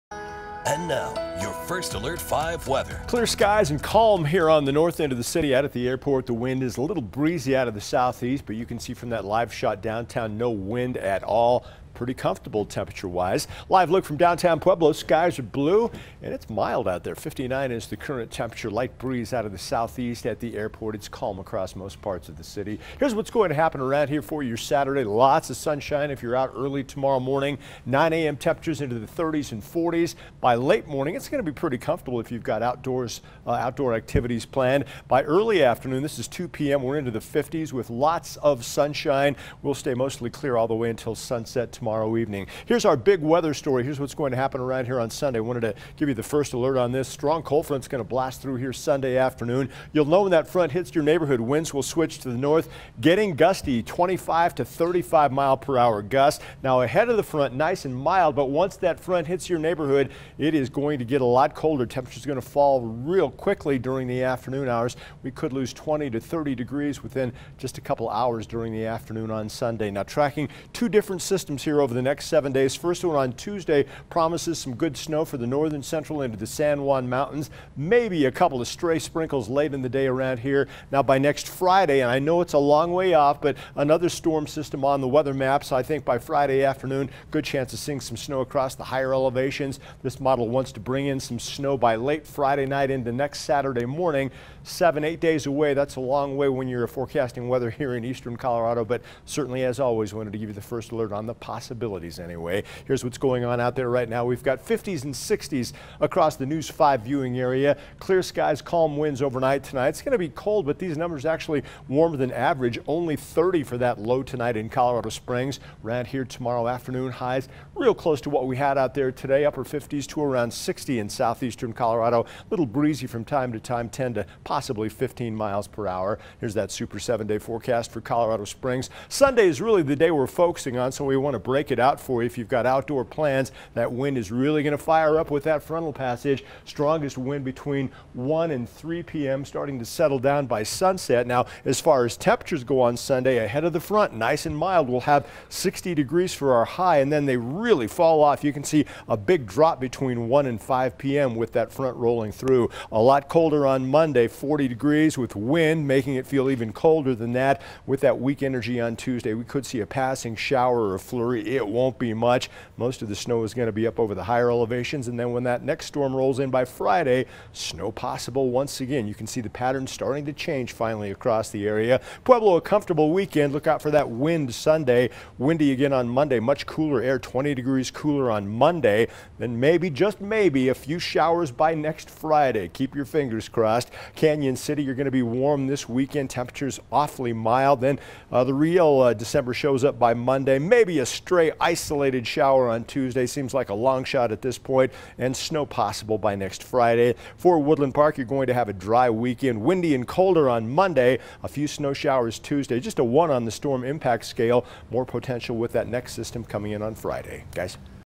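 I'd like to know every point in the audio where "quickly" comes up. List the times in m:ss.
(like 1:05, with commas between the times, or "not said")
1:03.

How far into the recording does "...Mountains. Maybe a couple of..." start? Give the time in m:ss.
1:17.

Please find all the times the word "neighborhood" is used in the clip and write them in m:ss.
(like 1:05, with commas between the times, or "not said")
0:51, 0:59.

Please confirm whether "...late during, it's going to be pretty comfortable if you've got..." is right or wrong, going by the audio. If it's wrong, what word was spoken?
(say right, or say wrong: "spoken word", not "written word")
wrong: "morning", not "during".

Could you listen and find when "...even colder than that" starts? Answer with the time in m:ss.
2:36.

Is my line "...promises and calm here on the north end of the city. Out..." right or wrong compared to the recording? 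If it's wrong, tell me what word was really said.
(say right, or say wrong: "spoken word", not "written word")
wrong: "skies", not "promises".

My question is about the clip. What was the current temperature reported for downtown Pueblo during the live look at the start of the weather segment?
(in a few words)
59.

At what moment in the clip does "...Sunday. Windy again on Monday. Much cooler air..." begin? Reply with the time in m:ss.
2:54.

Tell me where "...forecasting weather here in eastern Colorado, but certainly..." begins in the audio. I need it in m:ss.
1:36.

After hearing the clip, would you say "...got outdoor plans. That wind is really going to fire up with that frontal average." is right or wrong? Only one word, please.
wrong.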